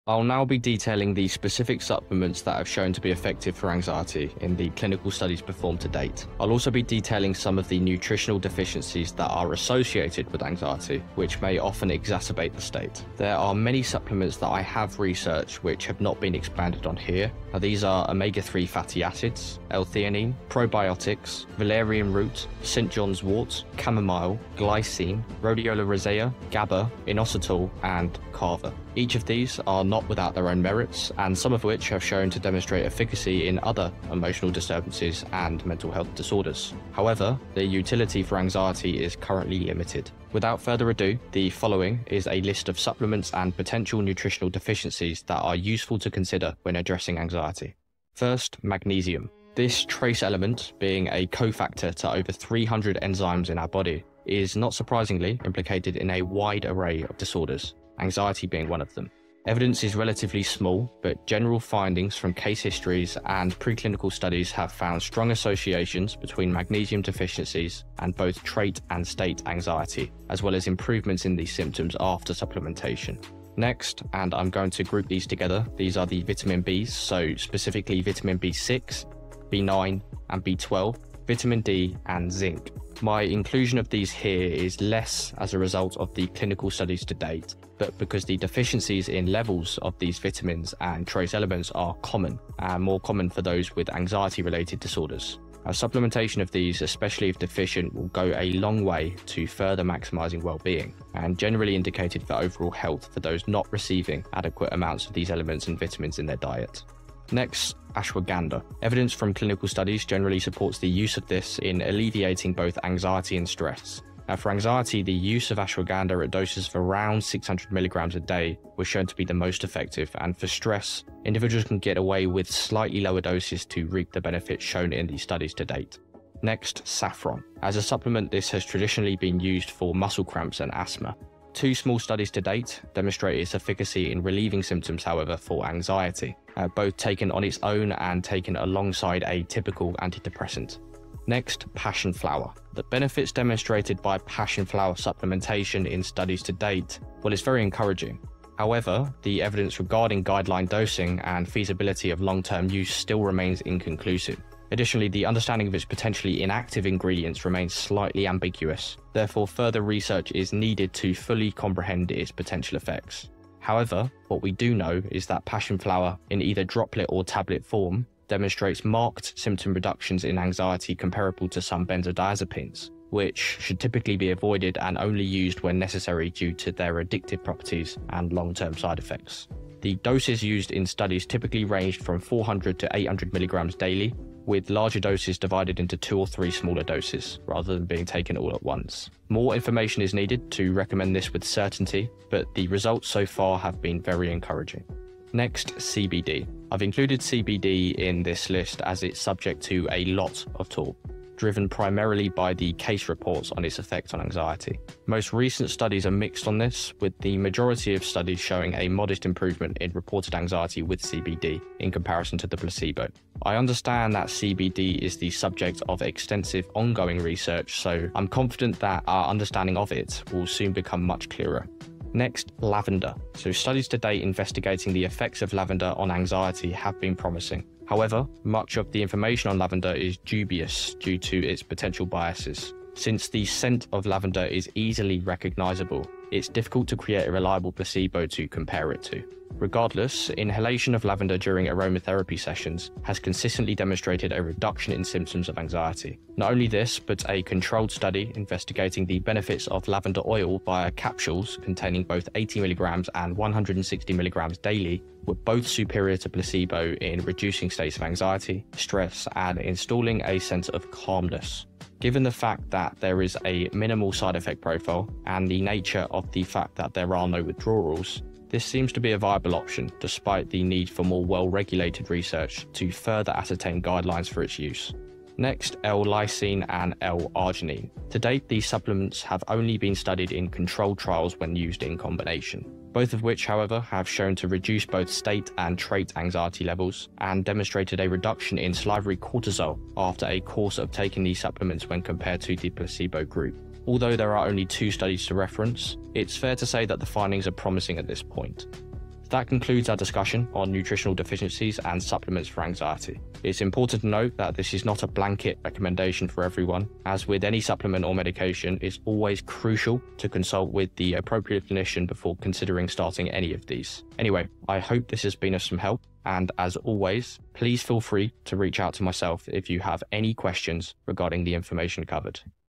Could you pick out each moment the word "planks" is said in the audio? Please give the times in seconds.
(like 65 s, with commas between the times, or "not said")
not said.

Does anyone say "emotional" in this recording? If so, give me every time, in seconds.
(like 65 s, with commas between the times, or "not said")
34 s.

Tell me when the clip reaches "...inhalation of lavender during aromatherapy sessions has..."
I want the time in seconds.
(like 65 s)
240 s.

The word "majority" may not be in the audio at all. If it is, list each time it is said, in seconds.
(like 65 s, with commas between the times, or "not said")
207 s.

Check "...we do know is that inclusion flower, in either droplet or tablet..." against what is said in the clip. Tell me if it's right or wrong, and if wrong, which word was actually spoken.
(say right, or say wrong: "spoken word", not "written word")
wrong: "passion", not "inclusion".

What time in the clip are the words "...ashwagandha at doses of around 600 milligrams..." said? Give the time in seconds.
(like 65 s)
115 s.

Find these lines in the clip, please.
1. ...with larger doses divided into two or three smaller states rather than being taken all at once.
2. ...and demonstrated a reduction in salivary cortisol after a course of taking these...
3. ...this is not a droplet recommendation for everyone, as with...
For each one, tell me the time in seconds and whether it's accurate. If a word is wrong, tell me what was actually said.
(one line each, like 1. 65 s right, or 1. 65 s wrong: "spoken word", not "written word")
1. 184 s wrong: "doses", not "states"
2. 287 s right
3. 304 s wrong: "blanket", not "droplet".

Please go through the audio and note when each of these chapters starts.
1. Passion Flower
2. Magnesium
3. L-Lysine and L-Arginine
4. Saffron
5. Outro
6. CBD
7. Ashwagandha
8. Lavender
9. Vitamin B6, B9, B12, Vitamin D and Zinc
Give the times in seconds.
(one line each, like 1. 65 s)
1. 141 s
2. 48 s
3. 275 s
4. 126 s
5. 299 s
6. 195 s
7. 107 s
8. 222 s
9. 73 s.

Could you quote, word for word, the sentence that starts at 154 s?
Additionally, the understanding of its potentially inactive ingredients remains slightly ambiguous.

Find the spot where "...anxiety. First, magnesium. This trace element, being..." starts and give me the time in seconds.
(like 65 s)
47 s.